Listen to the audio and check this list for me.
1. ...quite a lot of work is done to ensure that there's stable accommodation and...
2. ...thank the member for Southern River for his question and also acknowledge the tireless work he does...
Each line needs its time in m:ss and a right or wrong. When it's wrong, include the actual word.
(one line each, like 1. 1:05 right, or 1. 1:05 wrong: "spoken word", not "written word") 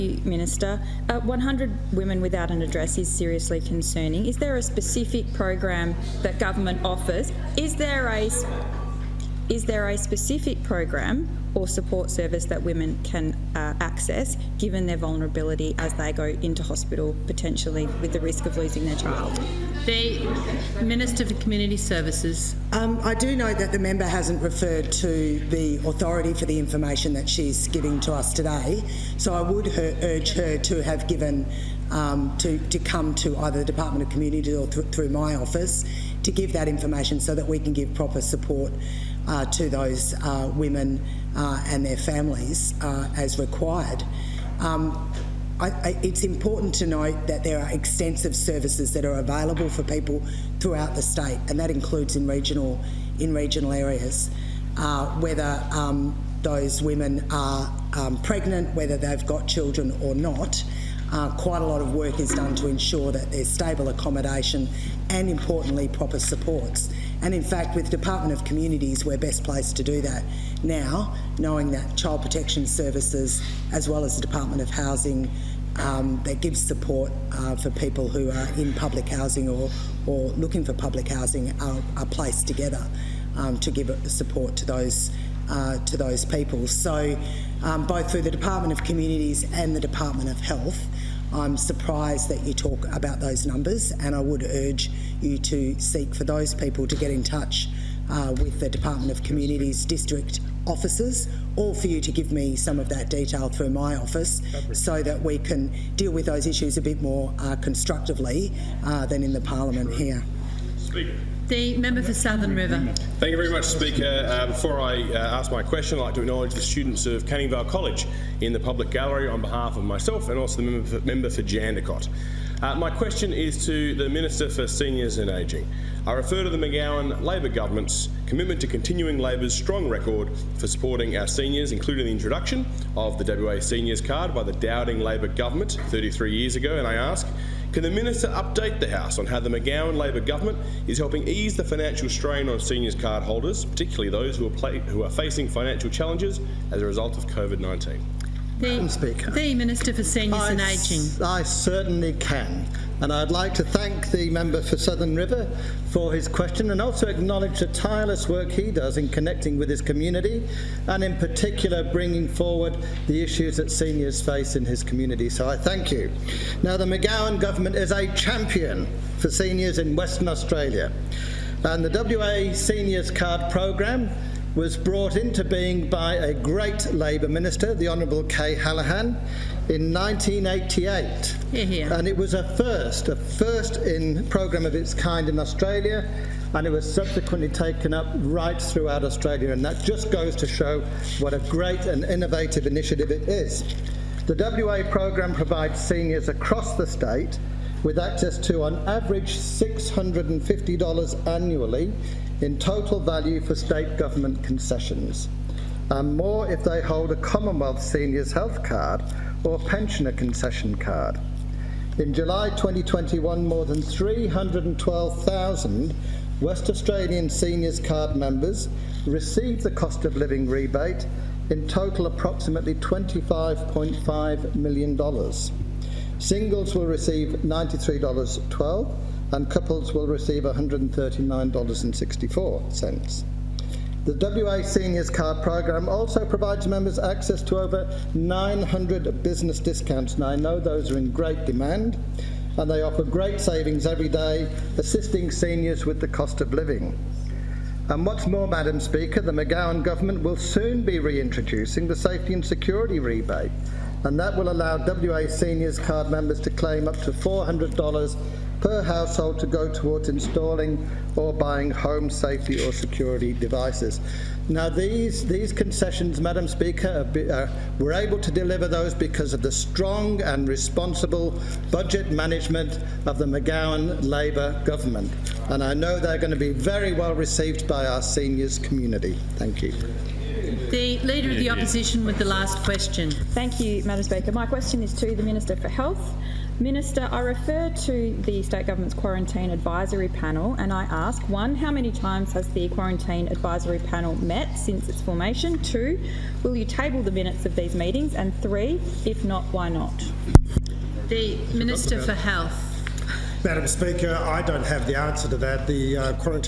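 1. 1:01 right
2. 2:33 right.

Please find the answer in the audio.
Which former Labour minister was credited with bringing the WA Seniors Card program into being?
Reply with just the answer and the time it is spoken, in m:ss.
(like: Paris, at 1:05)
Kay Hallahan, at 2:58.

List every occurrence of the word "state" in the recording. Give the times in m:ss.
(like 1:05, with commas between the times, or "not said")
0:51, 3:16, 3:23, 4:48.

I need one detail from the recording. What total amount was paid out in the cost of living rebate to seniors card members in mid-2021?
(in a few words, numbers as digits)
$25.5 million.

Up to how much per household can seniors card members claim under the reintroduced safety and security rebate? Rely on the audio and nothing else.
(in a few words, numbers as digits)
$400.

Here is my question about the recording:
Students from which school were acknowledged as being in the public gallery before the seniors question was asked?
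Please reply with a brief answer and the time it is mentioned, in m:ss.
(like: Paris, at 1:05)
Canning Vale College, at 1:57.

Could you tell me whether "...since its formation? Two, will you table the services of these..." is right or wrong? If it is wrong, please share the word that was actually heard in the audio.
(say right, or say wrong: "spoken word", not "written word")
wrong: "minutes", not "services".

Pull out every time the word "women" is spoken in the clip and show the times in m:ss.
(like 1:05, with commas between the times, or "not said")
0:01, 0:12, 0:40, 0:56.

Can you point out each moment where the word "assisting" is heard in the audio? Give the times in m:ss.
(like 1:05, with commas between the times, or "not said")
4:04.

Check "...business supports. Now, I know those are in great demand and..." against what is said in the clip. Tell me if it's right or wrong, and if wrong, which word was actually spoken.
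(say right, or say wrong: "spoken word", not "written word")
wrong: "discounts", not "supports".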